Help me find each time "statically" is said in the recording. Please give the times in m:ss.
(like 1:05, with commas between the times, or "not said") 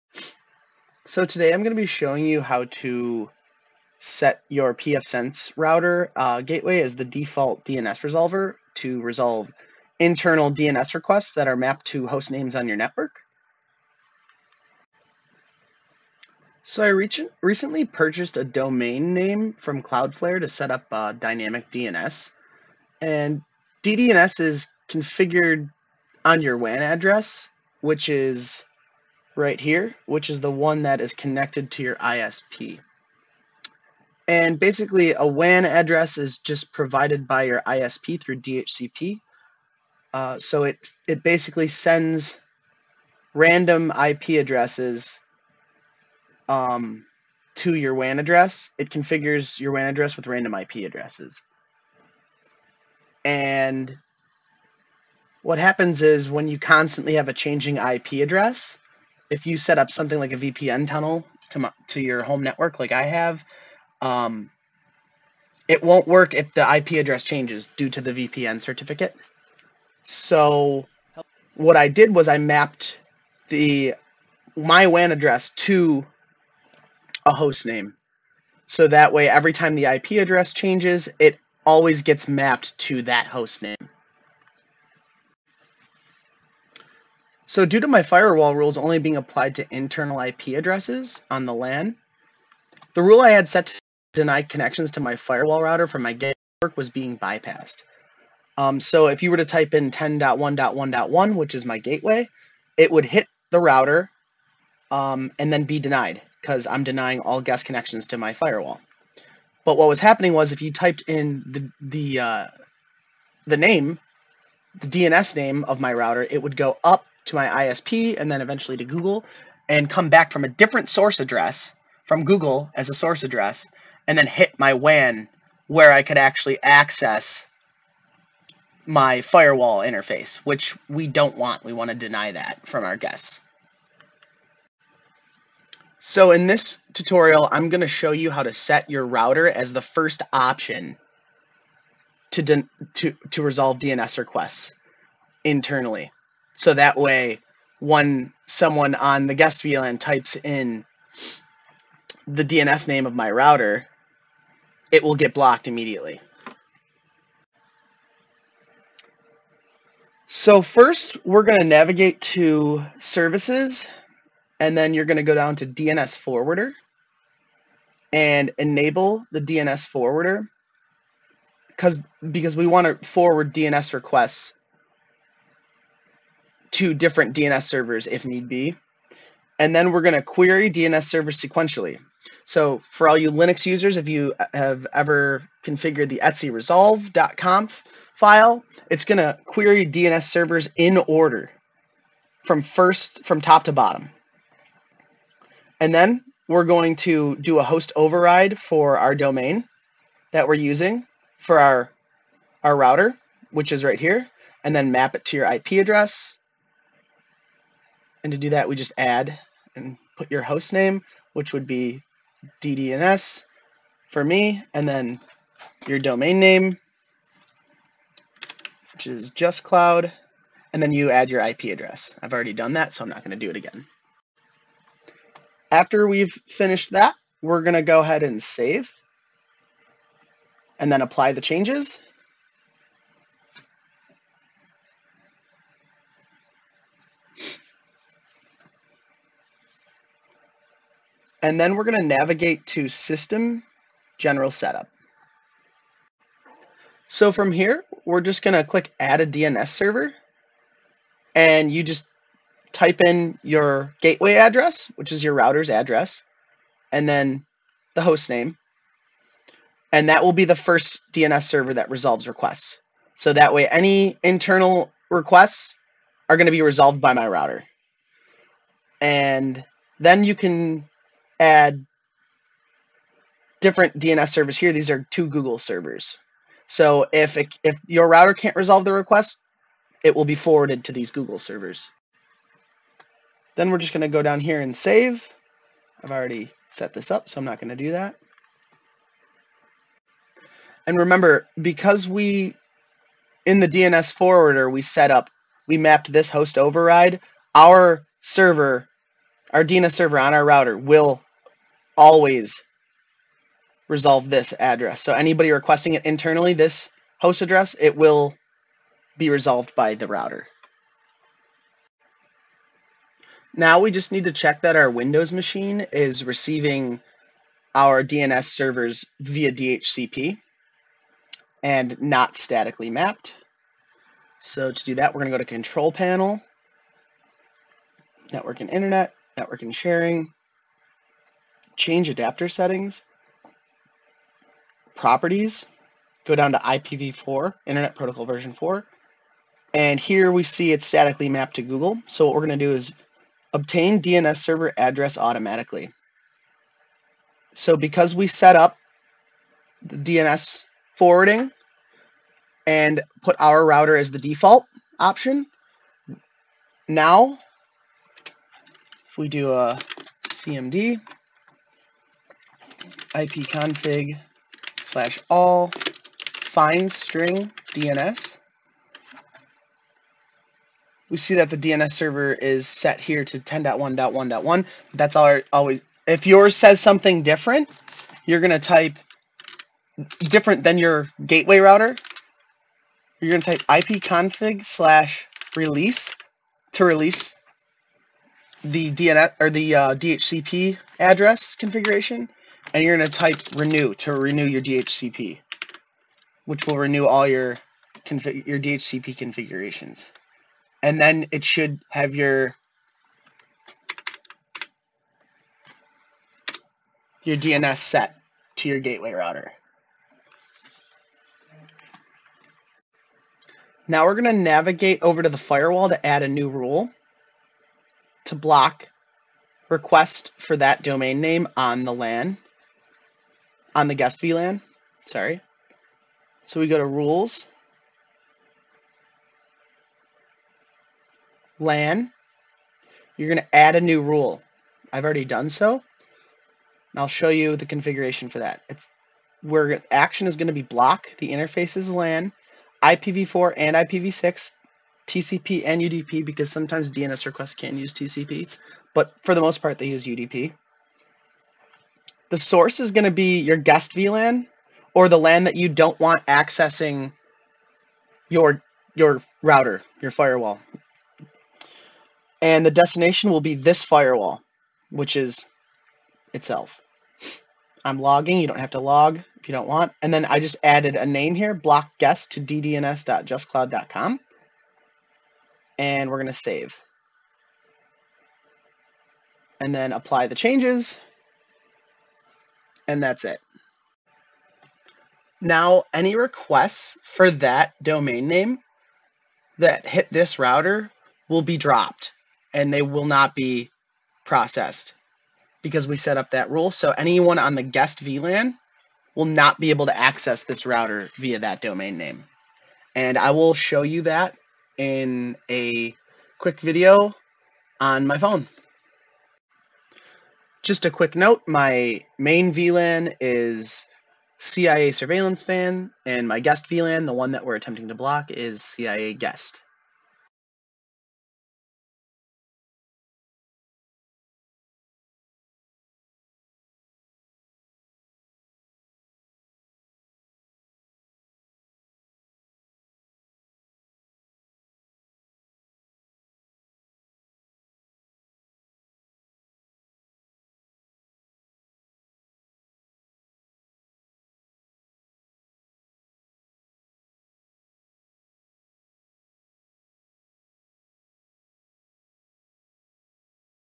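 5:22, 5:40.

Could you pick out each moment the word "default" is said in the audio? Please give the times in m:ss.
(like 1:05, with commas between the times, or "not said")
0:07, 5:54.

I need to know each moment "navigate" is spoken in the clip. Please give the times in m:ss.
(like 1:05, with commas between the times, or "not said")
2:41, 4:02, 6:54.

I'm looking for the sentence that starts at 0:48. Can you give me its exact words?
It configures your WAN address with random IP addresses.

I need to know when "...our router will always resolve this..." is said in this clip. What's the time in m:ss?
5:00.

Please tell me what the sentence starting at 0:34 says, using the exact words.
And basically, a WAN address is just provided by your ISP through DHCP.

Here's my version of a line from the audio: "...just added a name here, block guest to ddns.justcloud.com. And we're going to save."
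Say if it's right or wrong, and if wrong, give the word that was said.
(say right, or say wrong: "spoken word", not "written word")
right.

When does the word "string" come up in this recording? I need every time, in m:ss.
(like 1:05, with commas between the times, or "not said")
6:06.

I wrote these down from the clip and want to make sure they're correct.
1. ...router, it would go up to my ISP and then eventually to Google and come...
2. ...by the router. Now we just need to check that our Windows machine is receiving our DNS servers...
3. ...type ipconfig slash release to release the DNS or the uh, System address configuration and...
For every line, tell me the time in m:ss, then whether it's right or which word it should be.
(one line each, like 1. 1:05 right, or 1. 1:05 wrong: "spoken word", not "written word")
1. 1:55 right
2. 5:09 right
3. 6:23 wrong: "DHCP", not "System".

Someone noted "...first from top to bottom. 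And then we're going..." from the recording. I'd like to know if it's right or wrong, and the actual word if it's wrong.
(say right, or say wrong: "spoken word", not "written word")
right.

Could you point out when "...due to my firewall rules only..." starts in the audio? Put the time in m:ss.
1:27.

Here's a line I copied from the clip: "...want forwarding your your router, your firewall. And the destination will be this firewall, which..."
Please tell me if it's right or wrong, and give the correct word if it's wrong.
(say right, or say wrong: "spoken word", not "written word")
wrong: "accessing", not "forwarding".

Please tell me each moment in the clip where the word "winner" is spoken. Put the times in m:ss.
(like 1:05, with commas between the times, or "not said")
not said.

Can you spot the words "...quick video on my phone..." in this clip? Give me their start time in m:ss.
8:26.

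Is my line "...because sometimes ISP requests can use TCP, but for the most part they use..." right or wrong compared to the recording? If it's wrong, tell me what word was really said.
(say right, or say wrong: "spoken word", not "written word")
wrong: "DNS", not "ISP".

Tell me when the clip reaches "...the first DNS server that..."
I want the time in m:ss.
4:20.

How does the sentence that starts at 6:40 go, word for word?
And then it should have your your DNS set to your gateway router.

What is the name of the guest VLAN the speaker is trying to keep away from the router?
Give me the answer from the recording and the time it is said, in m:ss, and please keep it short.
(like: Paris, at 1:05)
CIA guest, at 8:38.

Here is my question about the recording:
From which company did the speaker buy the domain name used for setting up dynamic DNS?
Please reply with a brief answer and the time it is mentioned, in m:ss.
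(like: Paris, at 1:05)
Cloudflare, at 0:19.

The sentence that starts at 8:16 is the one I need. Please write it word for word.
So anyone on the guest VLAN will not be able to access this router via that domain name.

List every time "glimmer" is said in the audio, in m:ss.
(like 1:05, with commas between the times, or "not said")
not said.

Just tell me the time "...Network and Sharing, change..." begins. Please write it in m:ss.
5:29.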